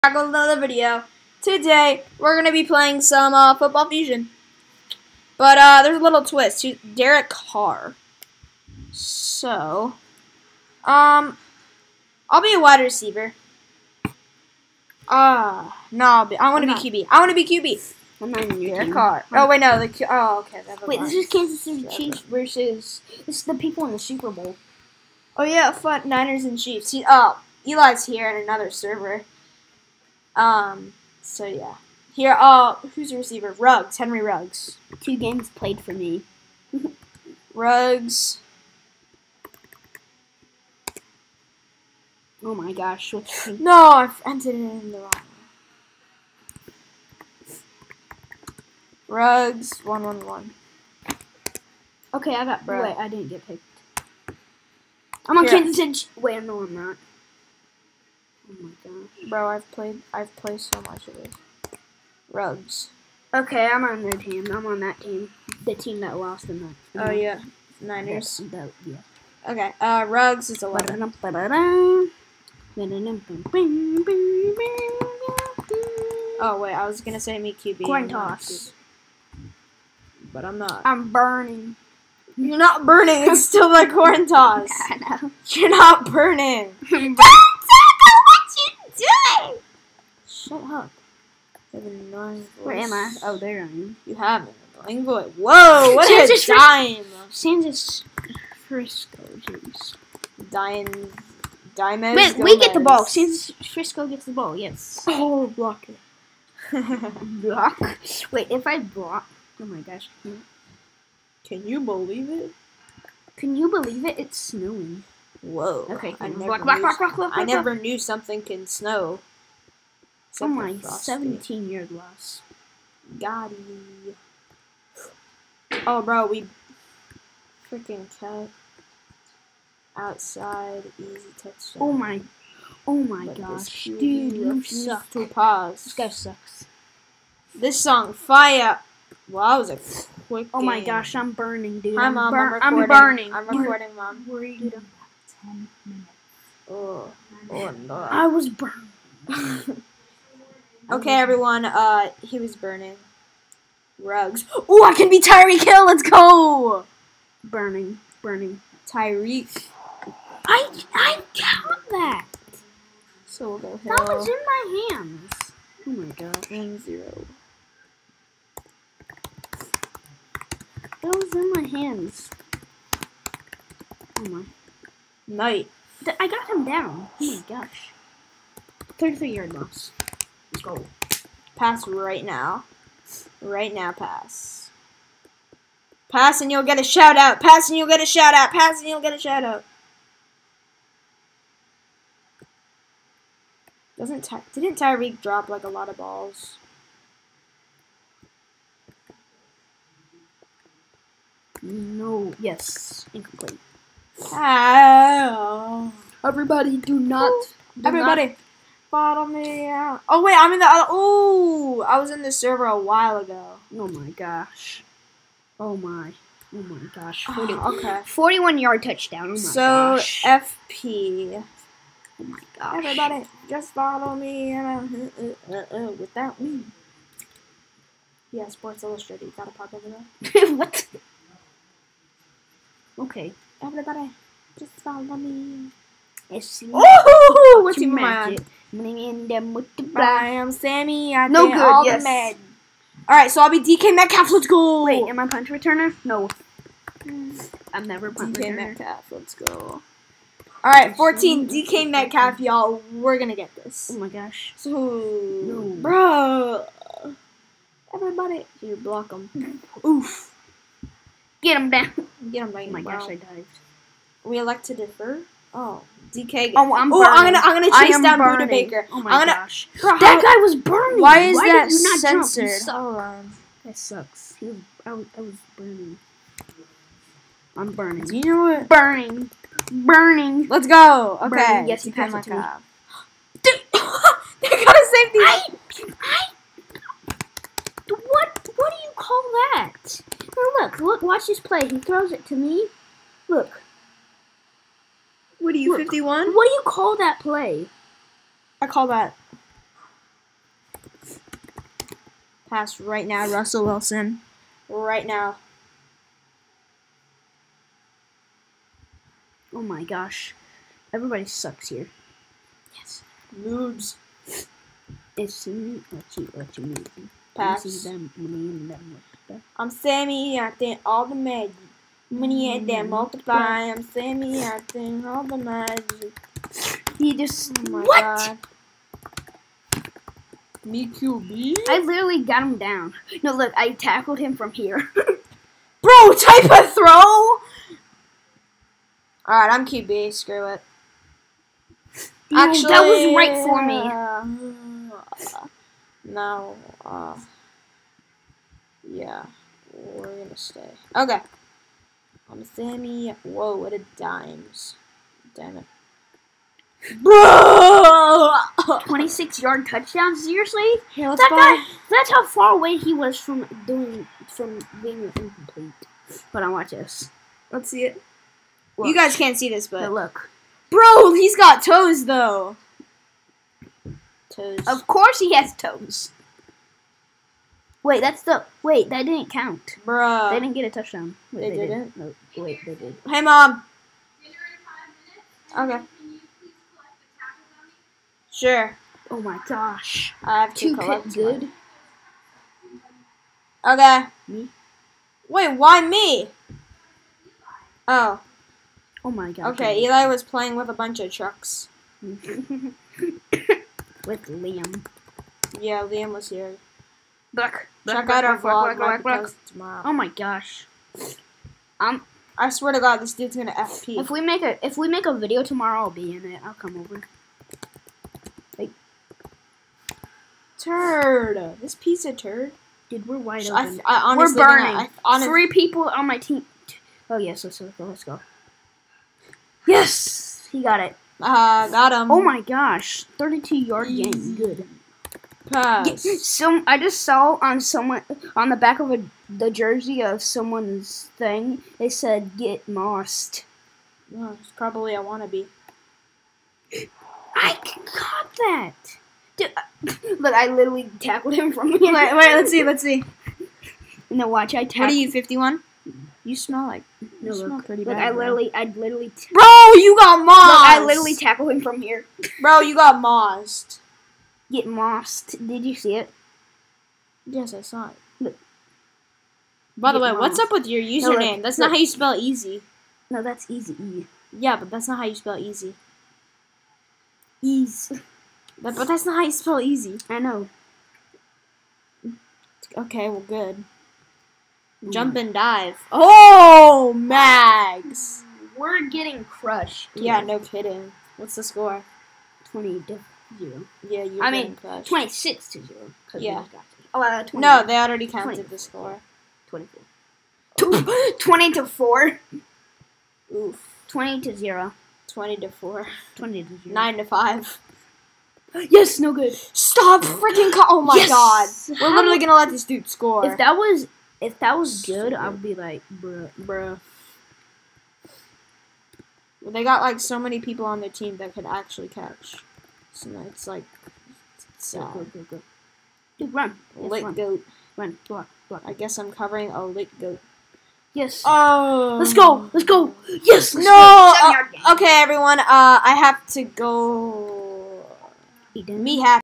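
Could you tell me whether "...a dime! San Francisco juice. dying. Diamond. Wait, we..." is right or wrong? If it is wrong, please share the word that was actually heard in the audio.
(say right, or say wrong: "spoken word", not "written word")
right.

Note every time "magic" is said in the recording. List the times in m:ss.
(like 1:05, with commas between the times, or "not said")
3:57, 5:21, 5:25.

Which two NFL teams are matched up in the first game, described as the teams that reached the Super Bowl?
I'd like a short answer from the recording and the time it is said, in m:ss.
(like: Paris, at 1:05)
Niners and Chiefs, at 0:26.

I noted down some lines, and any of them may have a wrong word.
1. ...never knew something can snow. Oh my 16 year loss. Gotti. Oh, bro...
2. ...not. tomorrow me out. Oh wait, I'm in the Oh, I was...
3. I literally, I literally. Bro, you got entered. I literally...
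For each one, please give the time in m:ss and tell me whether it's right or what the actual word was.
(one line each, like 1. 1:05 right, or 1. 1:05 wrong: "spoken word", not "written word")
1. 1:57 wrong: "17", not "16"
2. 3:28 wrong: "follow", not "tomorrow"
3. 7:38 wrong: "mossed", not "entered".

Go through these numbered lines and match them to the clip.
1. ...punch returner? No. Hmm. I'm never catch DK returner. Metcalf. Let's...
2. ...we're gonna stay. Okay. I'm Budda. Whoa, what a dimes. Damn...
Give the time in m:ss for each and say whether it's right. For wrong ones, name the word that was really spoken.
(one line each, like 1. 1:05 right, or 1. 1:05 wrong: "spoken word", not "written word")
1. 4:05 wrong: "punch", not "catch"
2. 5:49 wrong: "Sammy", not "Budda".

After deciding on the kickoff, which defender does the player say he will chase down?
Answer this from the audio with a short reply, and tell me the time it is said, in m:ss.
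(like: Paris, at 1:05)
Budda Baker, at 4:28.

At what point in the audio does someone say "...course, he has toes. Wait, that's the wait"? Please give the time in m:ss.
6:14.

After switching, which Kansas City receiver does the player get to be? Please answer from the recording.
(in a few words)
Tyreek Hill.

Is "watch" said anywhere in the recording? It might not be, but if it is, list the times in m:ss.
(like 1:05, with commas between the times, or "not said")
4:51, 6:06, 7:34.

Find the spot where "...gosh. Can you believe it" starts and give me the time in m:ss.
1:49.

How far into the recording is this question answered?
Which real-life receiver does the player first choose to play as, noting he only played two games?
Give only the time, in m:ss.
0:33.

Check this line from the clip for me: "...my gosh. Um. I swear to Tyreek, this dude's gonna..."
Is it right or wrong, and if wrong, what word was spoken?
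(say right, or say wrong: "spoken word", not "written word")
wrong: "God", not "Tyreek".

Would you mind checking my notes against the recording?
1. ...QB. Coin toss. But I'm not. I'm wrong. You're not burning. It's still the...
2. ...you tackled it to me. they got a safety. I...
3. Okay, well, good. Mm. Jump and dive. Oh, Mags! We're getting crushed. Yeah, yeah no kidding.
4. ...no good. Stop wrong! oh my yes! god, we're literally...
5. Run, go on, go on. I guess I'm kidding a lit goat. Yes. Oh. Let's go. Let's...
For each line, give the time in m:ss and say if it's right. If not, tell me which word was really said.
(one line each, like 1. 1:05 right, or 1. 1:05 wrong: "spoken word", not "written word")
1. 1:17 wrong: "burning", not "wrong"
2. 4:41 wrong: "passed", not "tackled"
3. 8:02 right
4. 8:28 wrong: "freaking", not "wrong"
5. 8:47 wrong: "covering", not "kidding".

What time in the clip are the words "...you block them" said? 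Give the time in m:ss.
4:18.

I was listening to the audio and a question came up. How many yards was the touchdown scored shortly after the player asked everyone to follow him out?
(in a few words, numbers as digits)
41.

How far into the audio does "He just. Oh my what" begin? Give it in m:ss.
5:26.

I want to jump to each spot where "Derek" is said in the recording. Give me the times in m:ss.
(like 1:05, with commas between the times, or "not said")
0:06, 0:18.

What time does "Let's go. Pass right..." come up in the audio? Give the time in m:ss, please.
3:00.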